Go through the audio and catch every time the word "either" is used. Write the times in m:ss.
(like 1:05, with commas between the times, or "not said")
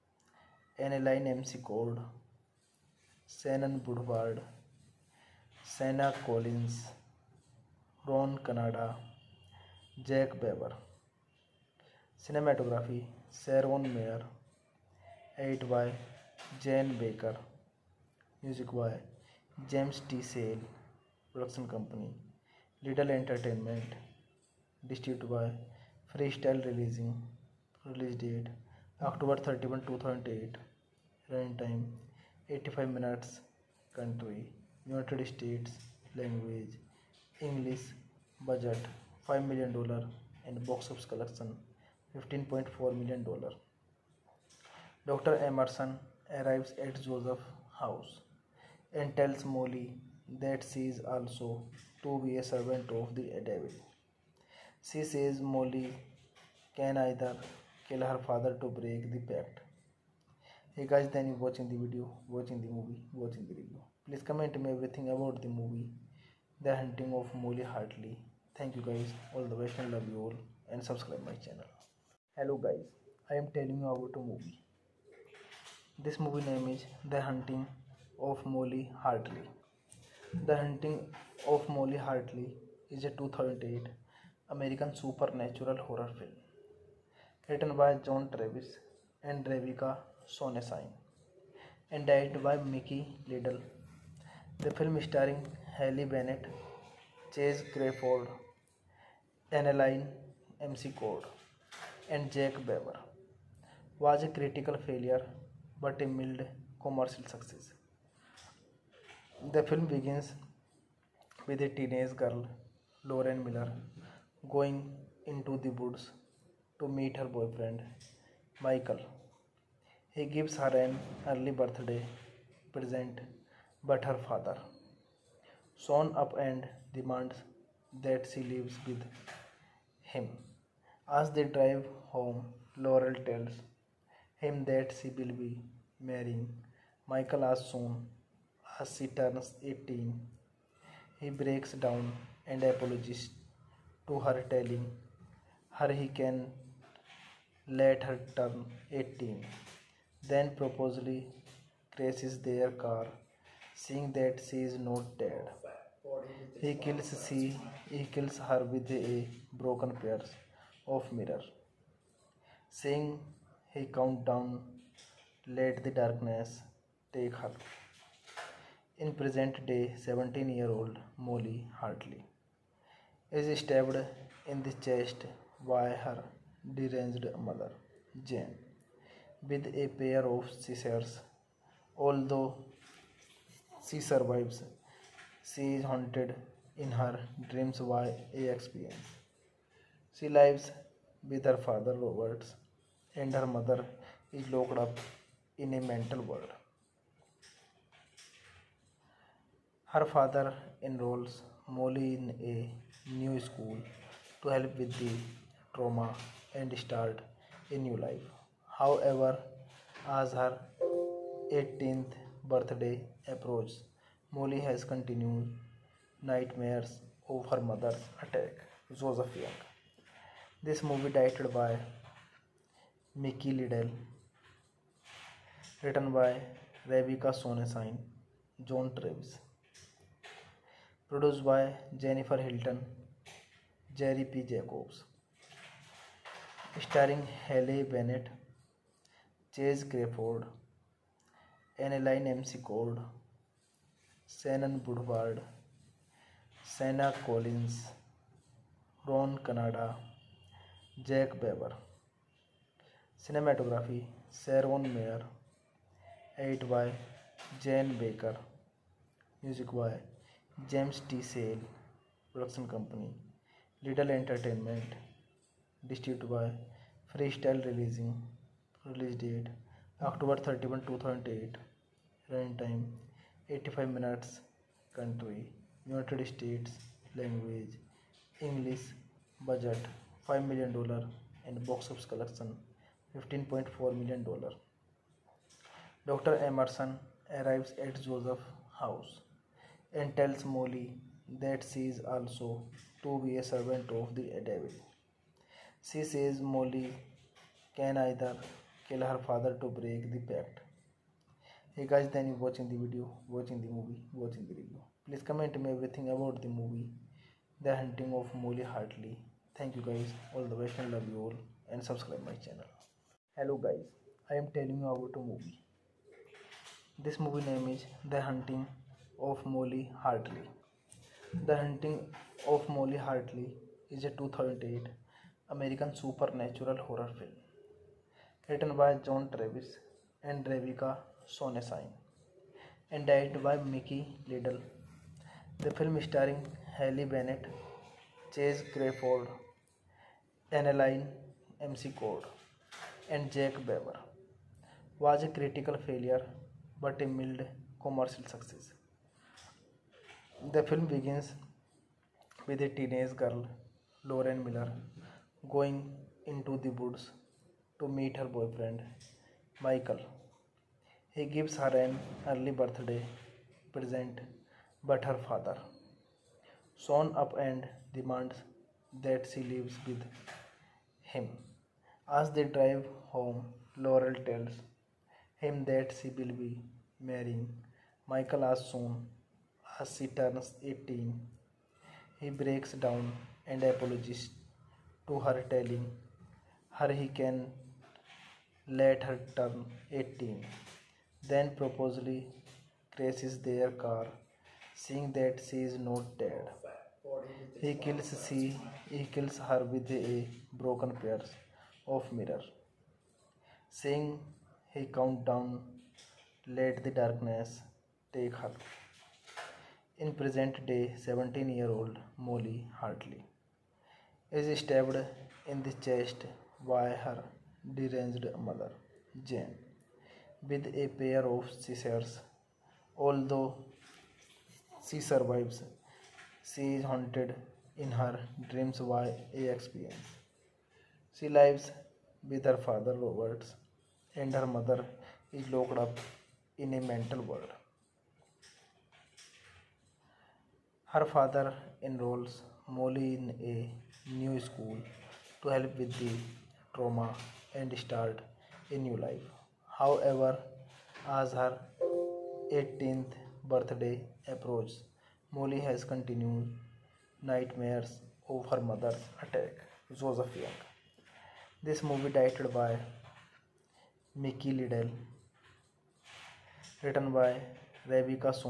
0:56, 4:57.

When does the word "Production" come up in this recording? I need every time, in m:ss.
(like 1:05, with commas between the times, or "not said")
0:21, 4:22.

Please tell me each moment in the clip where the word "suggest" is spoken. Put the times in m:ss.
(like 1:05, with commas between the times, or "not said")
not said.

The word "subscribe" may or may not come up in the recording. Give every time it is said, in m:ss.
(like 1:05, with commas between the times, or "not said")
1:10, 5:11.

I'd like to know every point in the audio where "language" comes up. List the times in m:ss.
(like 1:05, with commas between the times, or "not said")
0:36, 4:37.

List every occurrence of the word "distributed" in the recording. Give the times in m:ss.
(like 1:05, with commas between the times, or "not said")
0:24, 4:25.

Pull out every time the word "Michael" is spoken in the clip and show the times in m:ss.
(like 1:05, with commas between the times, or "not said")
1:58, 2:17, 5:59, 6:18.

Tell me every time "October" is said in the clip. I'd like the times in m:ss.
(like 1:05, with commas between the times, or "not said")
0:28, 4:29.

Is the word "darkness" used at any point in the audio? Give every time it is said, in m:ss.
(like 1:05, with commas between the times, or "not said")
2:45, 6:46.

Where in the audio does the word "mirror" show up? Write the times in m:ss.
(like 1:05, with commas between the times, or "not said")
2:41, 6:42.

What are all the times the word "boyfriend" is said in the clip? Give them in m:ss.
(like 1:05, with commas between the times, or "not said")
1:57, 5:58.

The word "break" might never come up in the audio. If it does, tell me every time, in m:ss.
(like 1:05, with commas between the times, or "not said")
0:58, 2:21, 4:59, 6:22.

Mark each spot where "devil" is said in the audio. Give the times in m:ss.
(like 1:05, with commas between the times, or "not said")
0:53, 4:54.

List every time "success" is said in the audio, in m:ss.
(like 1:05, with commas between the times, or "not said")
1:47.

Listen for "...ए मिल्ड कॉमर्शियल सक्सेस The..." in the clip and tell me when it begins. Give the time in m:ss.
5:47.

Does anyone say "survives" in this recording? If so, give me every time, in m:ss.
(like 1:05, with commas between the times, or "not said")
3:04, 7:05.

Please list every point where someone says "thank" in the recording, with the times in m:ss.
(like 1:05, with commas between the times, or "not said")
1:01, 1:08, 5:02, 5:09.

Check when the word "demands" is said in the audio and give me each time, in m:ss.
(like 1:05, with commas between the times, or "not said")
2:06, 6:07.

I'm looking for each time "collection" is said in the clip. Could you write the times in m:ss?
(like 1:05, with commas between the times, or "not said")
0:41, 4:42.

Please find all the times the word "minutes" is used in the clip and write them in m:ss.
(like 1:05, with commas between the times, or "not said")
0:32, 4:33.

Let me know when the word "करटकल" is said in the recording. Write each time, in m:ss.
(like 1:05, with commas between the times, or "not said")
5:45.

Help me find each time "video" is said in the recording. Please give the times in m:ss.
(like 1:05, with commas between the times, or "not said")
1:01, 5:02.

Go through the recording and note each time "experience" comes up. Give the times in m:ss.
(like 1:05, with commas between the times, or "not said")
3:08, 7:09.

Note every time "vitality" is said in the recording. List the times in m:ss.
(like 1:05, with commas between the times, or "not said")
not said.